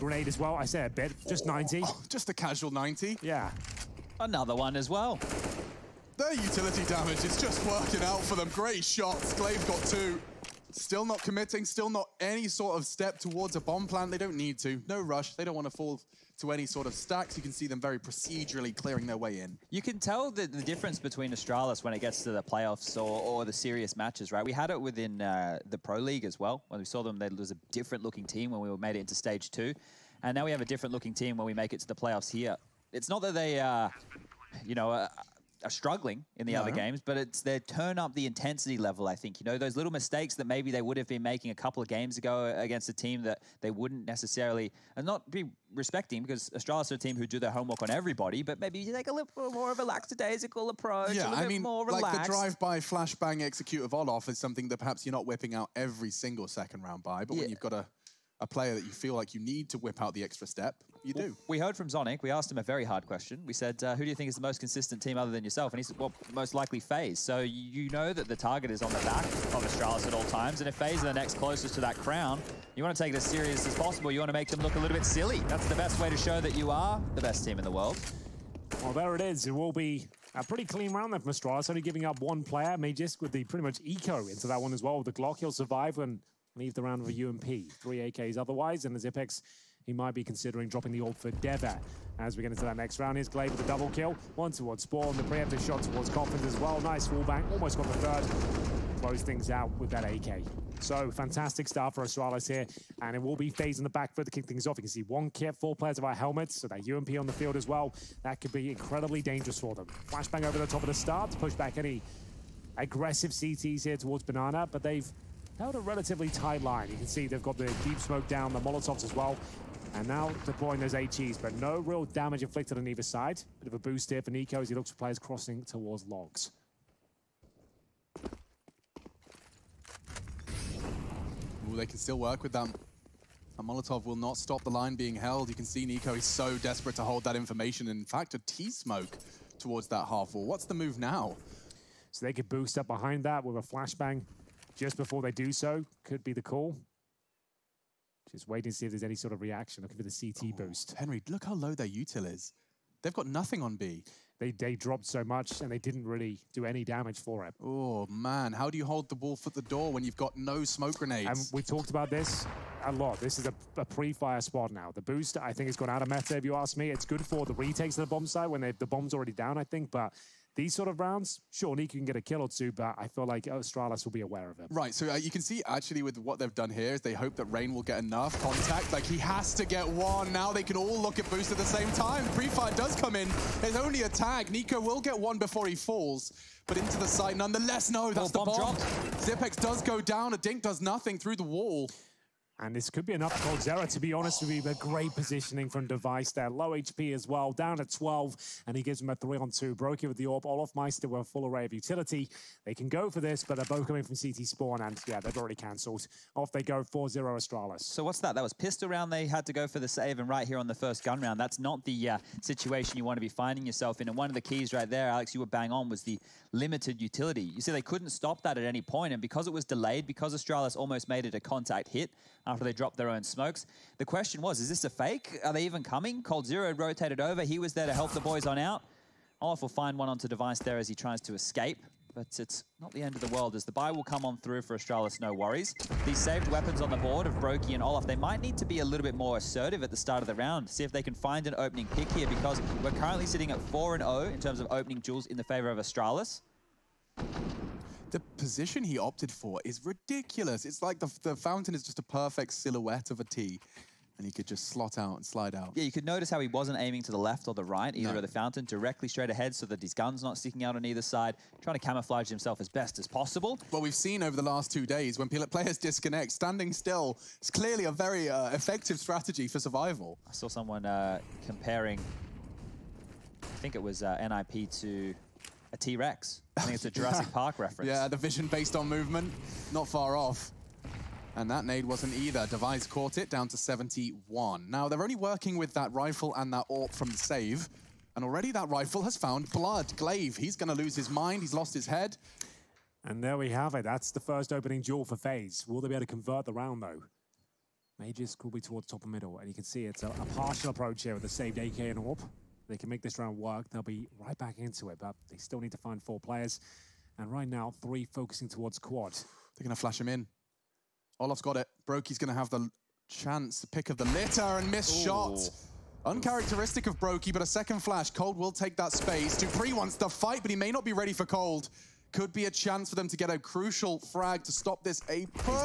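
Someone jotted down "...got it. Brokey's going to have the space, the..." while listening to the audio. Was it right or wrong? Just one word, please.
wrong.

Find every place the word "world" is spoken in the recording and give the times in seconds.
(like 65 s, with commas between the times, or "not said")
77 s, 233 s.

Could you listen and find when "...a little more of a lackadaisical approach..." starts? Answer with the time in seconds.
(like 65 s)
49 s.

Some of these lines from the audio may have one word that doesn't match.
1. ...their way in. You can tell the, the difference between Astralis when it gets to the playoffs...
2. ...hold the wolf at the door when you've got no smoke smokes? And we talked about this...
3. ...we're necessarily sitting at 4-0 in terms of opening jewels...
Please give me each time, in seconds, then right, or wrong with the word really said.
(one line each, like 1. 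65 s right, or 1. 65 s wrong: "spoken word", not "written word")
1. 19 s right
2. 158 s wrong: "grenades", not "smokes"
3. 242 s wrong: "currently", not "necessarily".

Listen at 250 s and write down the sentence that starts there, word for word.
It's like the, the fountain is just a perfect silhouette of a T.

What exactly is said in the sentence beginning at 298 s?
Magisk will be towards top and middle.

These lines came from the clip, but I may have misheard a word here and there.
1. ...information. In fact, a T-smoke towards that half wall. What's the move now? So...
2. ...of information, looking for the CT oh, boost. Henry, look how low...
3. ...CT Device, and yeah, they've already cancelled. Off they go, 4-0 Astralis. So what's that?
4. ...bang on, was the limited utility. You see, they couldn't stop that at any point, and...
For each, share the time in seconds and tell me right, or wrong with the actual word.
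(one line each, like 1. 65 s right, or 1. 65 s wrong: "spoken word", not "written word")
1. 137 s right
2. 149 s wrong: "reaction", not "information"
3. 204 s wrong: "Spawn", not "Device"
4. 215 s right.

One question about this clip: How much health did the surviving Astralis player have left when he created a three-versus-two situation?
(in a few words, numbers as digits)
12.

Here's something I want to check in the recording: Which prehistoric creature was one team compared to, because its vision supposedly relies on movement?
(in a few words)
T-Rex.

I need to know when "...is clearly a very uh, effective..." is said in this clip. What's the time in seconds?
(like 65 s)
267 s.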